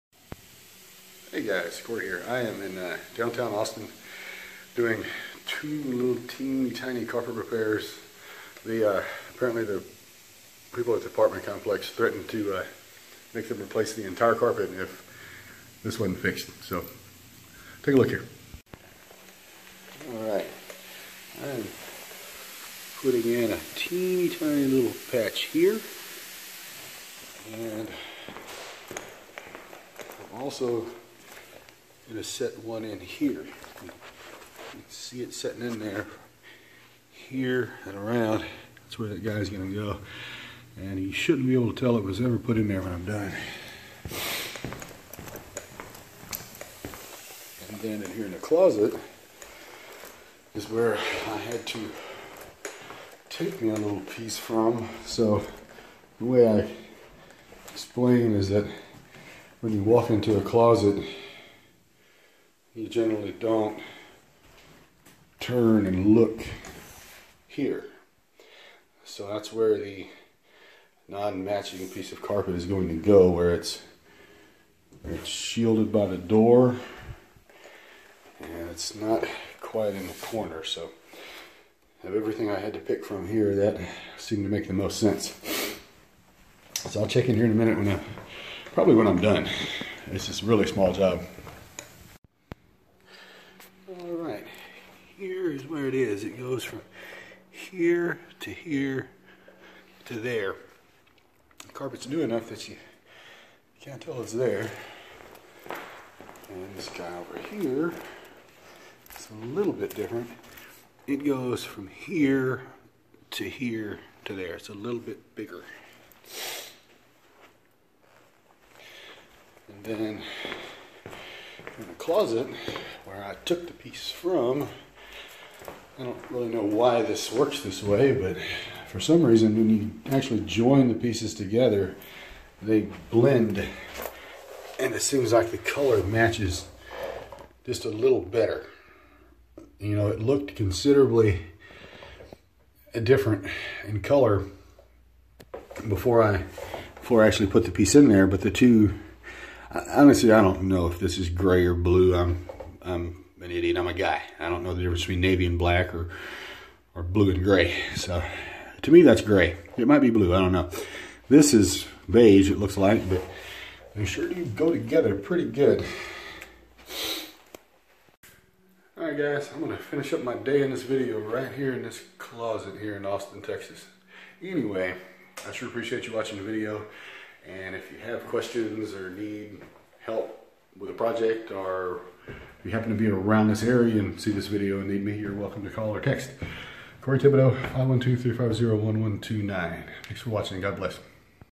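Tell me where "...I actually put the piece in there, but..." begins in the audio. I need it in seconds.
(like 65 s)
147 s.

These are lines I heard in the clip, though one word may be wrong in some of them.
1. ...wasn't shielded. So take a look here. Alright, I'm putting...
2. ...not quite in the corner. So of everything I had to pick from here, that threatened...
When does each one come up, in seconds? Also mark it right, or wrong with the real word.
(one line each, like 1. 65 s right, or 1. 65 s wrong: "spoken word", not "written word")
1. 16 s wrong: "fixed", not "shielded"
2. 78 s wrong: "seemed", not "threatened".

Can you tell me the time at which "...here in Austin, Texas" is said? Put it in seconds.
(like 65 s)
172 s.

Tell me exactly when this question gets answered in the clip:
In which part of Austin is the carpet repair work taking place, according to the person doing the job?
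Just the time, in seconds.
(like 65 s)
3 s.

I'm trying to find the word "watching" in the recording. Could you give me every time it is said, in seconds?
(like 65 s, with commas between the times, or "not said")
176 s, 190 s.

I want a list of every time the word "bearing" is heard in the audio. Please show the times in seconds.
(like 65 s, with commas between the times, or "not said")
not said.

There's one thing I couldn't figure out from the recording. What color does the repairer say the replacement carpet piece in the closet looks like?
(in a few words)
Beige.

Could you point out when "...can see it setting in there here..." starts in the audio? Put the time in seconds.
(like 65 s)
34 s.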